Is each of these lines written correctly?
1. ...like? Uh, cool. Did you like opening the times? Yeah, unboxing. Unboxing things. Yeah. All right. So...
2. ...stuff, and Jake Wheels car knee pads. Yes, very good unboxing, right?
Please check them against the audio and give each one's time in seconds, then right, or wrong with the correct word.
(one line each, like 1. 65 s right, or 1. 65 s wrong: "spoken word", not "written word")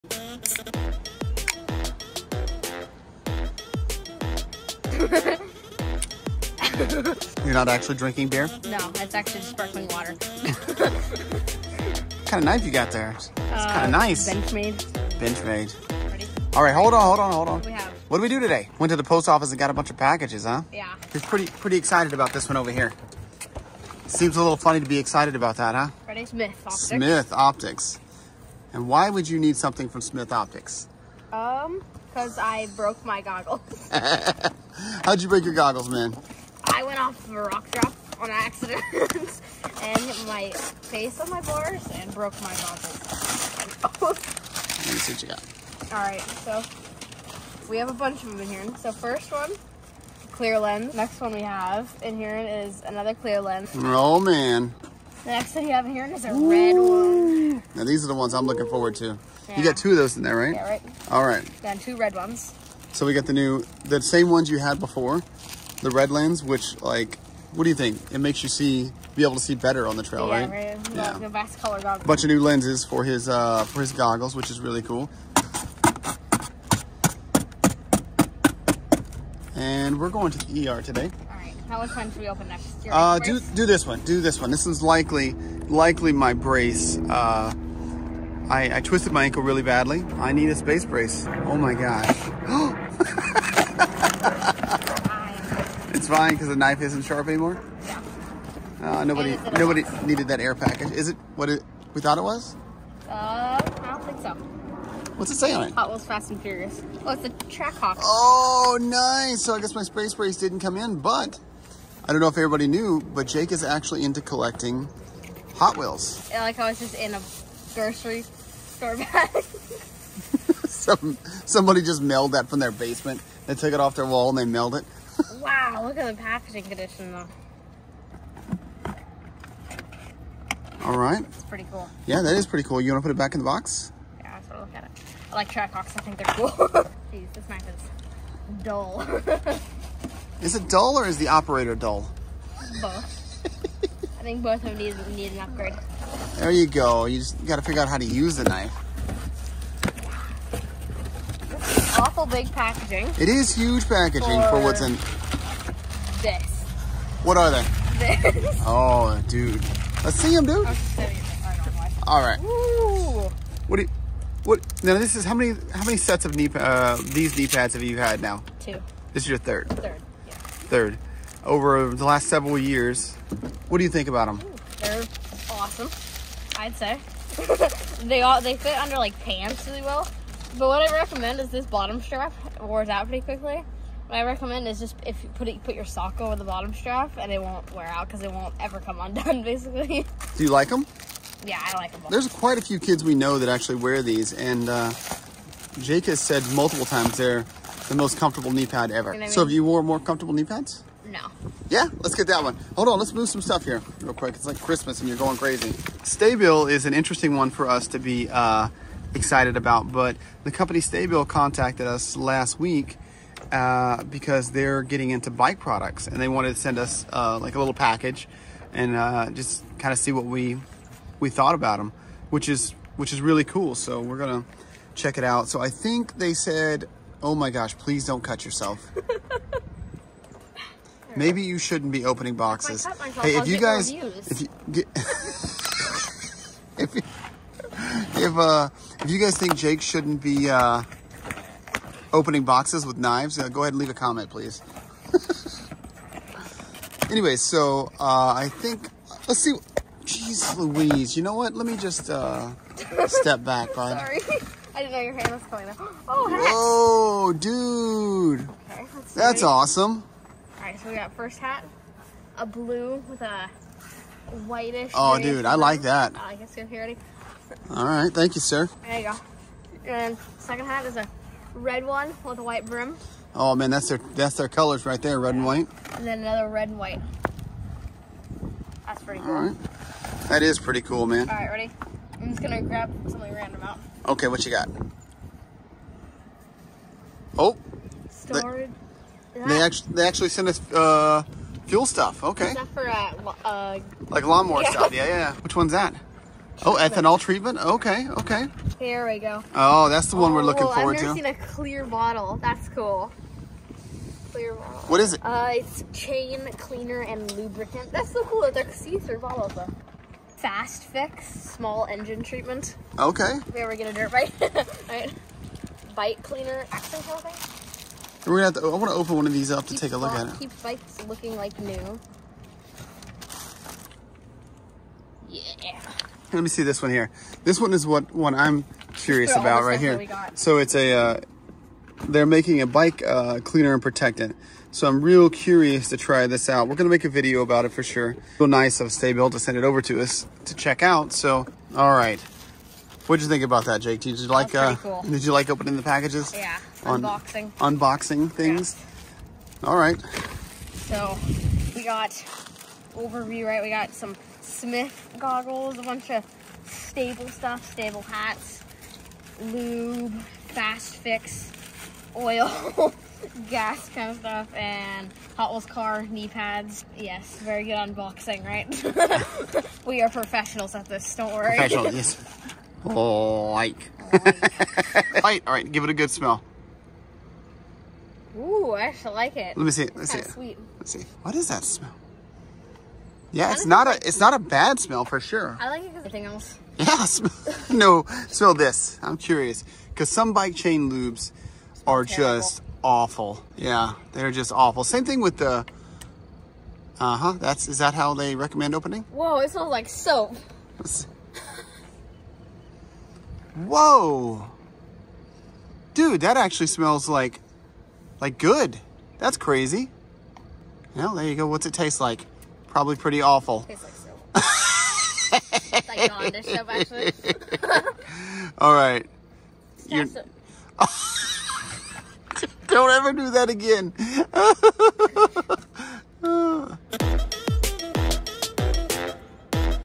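1. 344 s wrong: "packages", not "times"
2. 364 s wrong: "Hot", not "Jake".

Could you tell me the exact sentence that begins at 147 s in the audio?
You just gotta figure out how to use the knife.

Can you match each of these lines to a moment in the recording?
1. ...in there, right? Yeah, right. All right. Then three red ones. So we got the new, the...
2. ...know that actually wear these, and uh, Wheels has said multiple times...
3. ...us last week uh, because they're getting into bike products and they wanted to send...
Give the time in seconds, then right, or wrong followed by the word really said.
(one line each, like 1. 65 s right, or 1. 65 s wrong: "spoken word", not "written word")
1. 60 s wrong: "two", not "three"
2. 193 s wrong: "Jake", not "Wheels"
3. 211 s right.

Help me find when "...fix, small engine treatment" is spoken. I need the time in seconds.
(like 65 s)
310 s.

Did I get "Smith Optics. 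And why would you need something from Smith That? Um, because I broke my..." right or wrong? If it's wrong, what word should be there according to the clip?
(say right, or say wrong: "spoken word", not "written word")
wrong: "Optics", not "That".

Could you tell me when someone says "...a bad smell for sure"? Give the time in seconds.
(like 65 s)
384 s.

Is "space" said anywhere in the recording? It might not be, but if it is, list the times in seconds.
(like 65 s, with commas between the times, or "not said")
90 s, 109 s.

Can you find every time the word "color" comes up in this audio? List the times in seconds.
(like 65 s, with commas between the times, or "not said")
71 s, 274 s.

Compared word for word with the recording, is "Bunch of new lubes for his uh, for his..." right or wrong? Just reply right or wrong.
wrong.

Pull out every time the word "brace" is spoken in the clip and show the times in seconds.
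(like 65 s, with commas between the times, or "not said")
86 s, 90 s.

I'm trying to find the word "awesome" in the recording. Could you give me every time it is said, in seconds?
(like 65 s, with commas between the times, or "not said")
175 s, 259 s.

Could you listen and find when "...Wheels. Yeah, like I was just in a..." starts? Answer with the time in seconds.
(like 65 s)
115 s.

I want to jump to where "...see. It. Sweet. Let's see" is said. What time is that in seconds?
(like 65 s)
380 s.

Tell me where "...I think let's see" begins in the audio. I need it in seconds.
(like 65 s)
248 s.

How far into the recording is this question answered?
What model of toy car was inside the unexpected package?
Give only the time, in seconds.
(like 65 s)
107 s.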